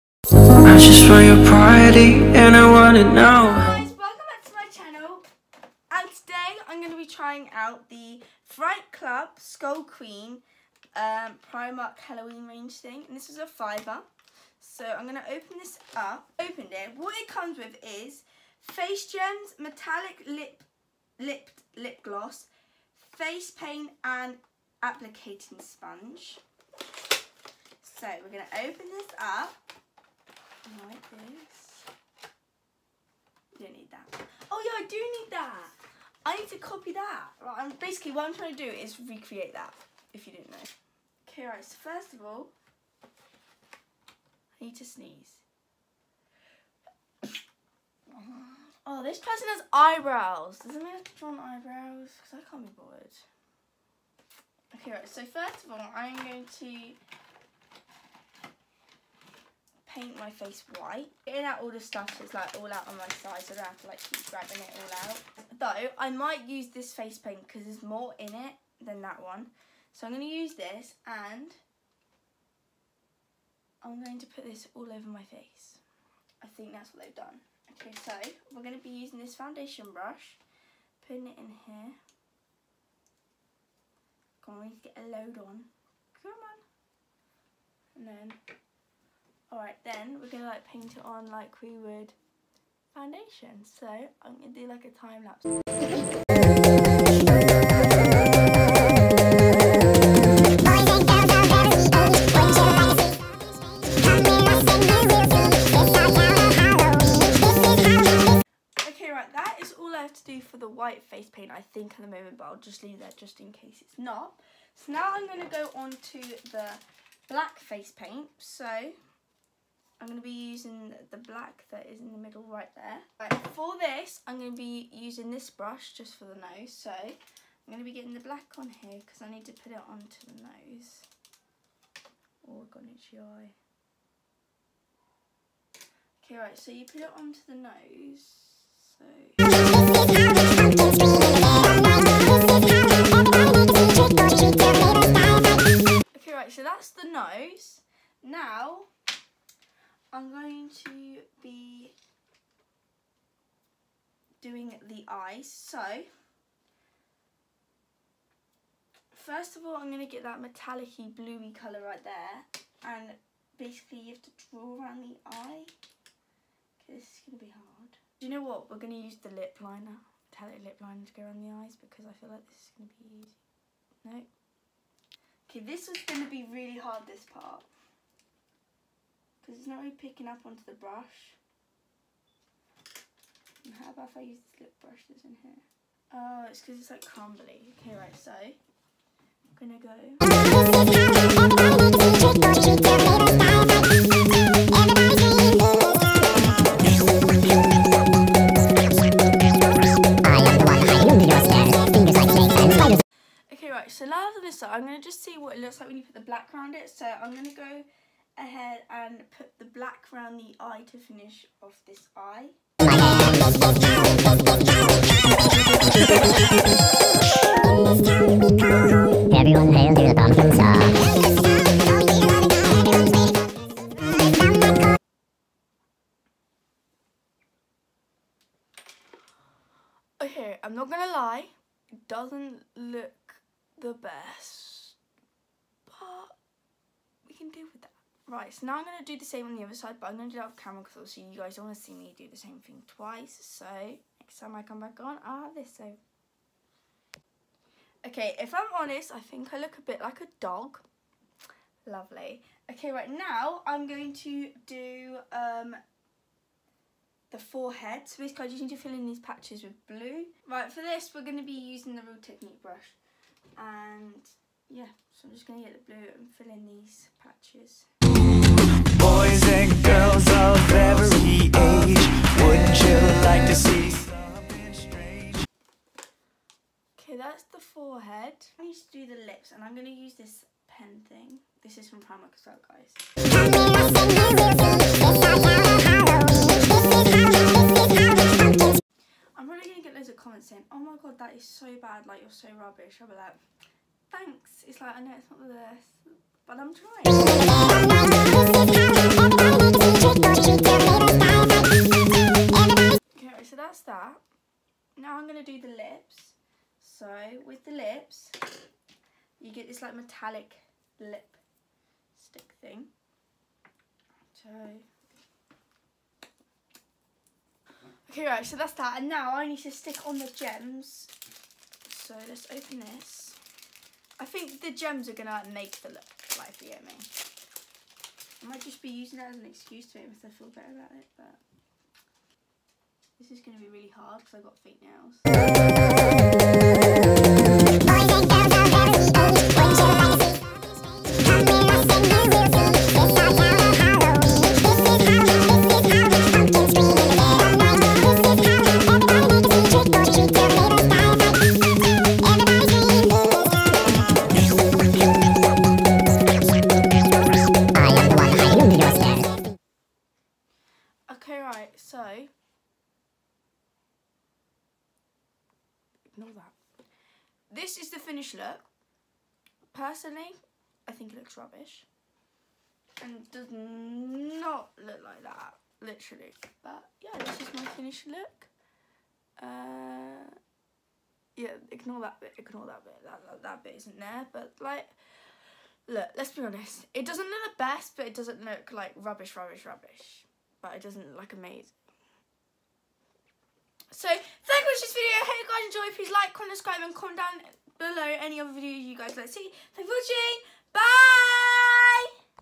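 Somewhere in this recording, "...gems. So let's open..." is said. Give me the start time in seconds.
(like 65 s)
320 s.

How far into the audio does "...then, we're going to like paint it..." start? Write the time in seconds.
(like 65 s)
89 s.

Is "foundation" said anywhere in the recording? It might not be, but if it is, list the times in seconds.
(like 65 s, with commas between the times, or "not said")
79 s, 92 s.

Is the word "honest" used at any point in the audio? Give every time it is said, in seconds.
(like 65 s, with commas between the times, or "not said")
248 s, 386 s.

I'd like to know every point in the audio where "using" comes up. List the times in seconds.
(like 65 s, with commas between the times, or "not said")
78 s, 120 s, 124 s, 261 s, 328 s.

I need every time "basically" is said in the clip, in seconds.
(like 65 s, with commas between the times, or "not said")
37 s, 163 s, 258 s.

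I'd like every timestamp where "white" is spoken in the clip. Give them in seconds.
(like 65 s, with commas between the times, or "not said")
60 s, 110 s.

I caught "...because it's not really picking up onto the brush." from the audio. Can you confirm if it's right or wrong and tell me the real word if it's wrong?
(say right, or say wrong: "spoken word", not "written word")
right.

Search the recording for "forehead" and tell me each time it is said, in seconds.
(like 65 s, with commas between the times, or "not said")
257 s, 277 s.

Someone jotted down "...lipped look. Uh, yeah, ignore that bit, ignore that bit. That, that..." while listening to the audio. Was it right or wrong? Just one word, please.
wrong.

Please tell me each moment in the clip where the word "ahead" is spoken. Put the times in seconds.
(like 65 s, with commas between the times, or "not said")
208 s.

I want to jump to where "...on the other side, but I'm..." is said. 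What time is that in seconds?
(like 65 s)
239 s.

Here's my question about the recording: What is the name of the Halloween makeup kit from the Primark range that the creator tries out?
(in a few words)
Fright Club Skull Queen.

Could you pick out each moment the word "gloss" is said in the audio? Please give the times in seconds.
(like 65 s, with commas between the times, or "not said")
22 s.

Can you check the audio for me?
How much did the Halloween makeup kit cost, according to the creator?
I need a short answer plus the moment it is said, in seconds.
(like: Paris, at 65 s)
a fiver, at 13 s.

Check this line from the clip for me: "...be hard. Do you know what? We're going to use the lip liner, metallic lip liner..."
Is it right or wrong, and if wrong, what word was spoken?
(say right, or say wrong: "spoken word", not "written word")
right.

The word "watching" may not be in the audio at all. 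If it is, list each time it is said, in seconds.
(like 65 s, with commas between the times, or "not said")
394 s, 399 s.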